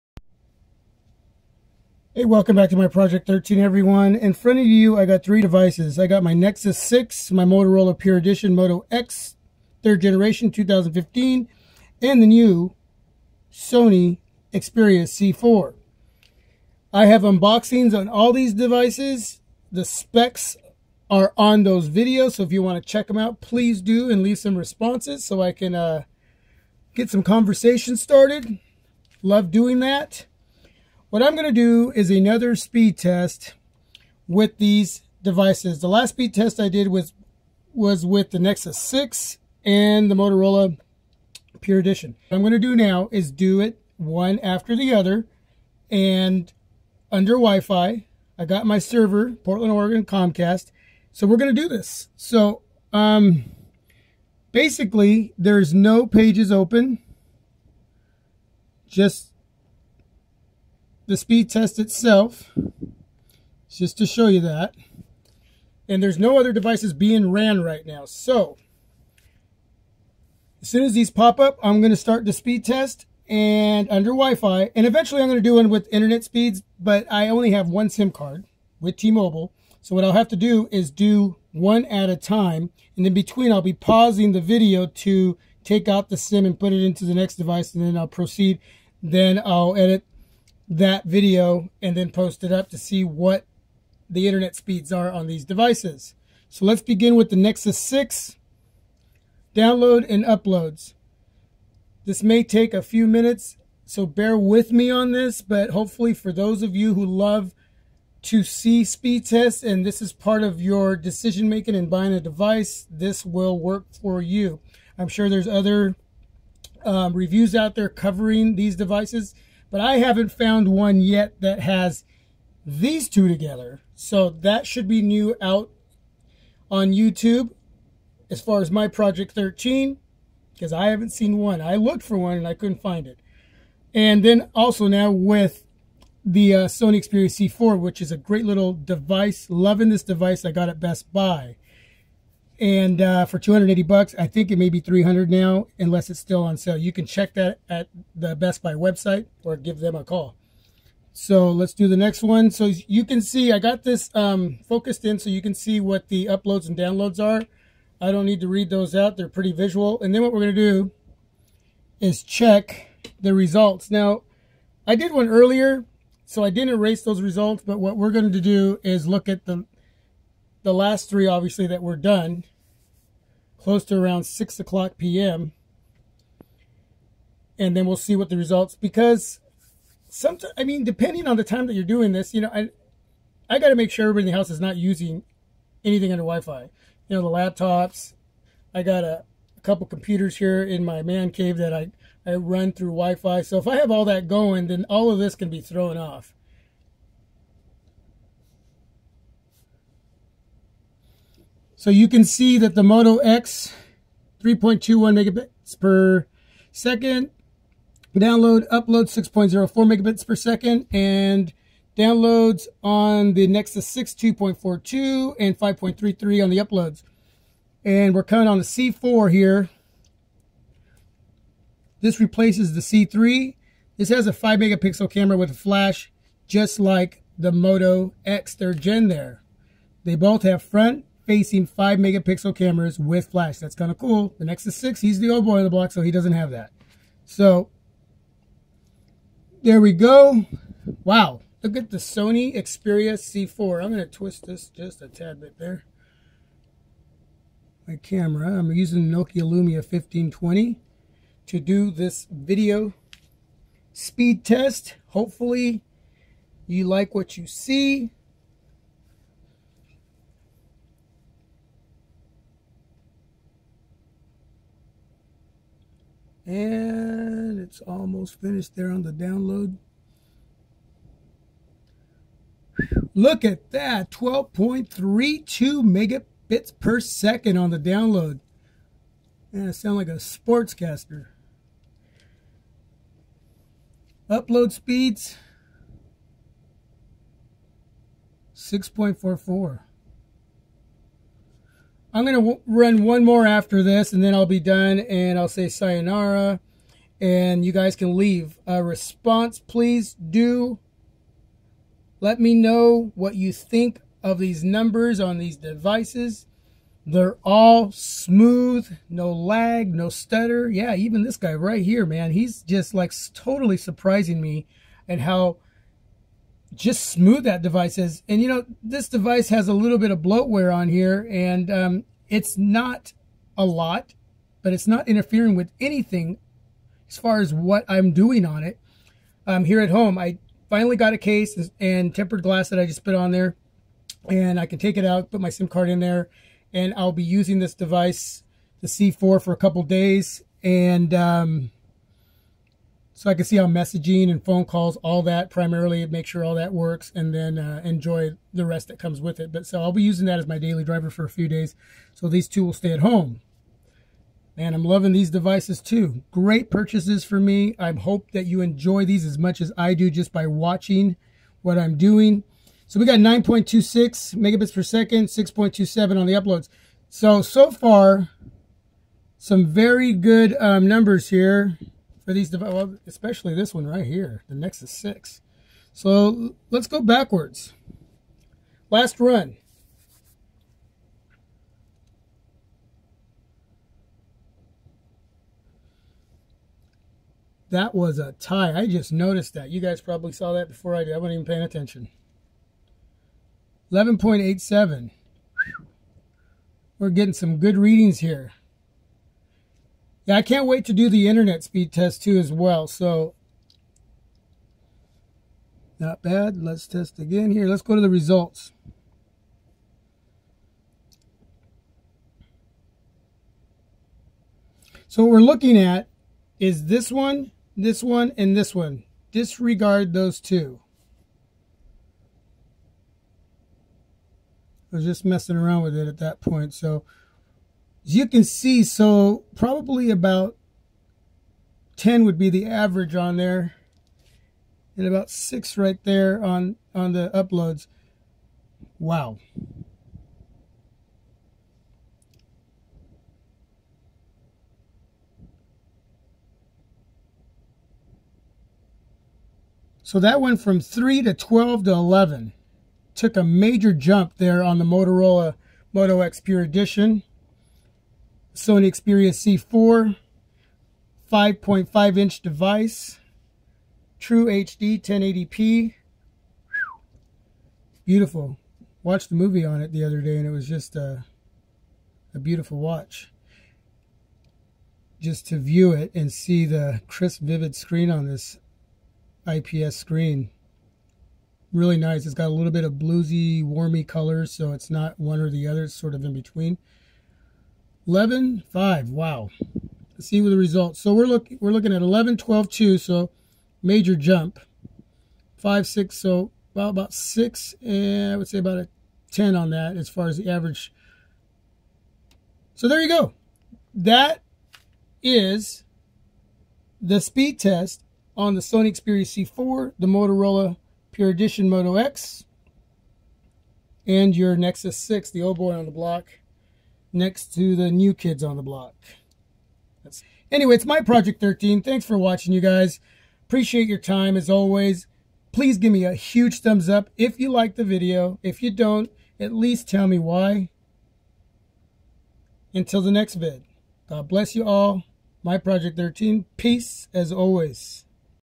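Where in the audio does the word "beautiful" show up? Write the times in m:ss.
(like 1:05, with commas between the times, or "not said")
7:48, 7:52.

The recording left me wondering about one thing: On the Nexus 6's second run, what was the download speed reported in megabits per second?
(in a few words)
9.26.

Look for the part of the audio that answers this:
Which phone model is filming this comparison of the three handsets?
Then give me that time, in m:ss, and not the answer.
4:09.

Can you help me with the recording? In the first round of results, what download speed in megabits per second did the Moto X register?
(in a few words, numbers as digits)
3.21.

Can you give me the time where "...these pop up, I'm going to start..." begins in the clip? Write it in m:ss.
1:10.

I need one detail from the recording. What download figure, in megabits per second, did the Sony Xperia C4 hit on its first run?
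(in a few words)
12.32.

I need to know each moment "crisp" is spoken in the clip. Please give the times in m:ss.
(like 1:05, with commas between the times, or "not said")
7:57.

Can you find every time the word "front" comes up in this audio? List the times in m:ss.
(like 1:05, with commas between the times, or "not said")
0:04, 3:50.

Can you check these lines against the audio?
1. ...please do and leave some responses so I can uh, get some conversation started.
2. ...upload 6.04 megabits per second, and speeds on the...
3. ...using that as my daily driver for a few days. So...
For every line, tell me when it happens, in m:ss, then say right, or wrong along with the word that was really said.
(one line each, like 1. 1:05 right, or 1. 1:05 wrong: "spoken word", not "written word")
1. 0:23 right
2. 3:28 wrong: "downloads", not "speeds"
3. 5:50 right.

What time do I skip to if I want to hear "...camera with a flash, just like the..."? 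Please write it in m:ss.
3:45.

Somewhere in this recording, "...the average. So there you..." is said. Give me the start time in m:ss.
8:20.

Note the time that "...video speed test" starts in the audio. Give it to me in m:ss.
4:12.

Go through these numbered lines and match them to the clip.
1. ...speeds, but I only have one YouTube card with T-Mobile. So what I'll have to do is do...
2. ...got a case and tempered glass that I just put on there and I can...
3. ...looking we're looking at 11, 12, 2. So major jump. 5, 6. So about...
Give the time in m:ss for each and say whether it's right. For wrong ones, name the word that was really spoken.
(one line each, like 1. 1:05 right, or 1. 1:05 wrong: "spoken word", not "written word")
1. 1:16 wrong: "SIM", not "YouTube"
2. 5:30 right
3. 8:11 right.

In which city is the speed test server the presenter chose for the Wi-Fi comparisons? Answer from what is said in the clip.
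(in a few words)
Portland, Oregon.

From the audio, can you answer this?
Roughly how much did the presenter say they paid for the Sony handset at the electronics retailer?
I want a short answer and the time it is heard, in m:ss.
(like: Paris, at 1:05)
280 bucks, at 2:23.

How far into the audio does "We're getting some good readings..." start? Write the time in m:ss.
6:36.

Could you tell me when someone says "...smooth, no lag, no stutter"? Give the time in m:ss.
5:07.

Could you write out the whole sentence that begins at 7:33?
Took a major jump there on the Motorola Moto X Pure Edition.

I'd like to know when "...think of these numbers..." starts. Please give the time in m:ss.
5:03.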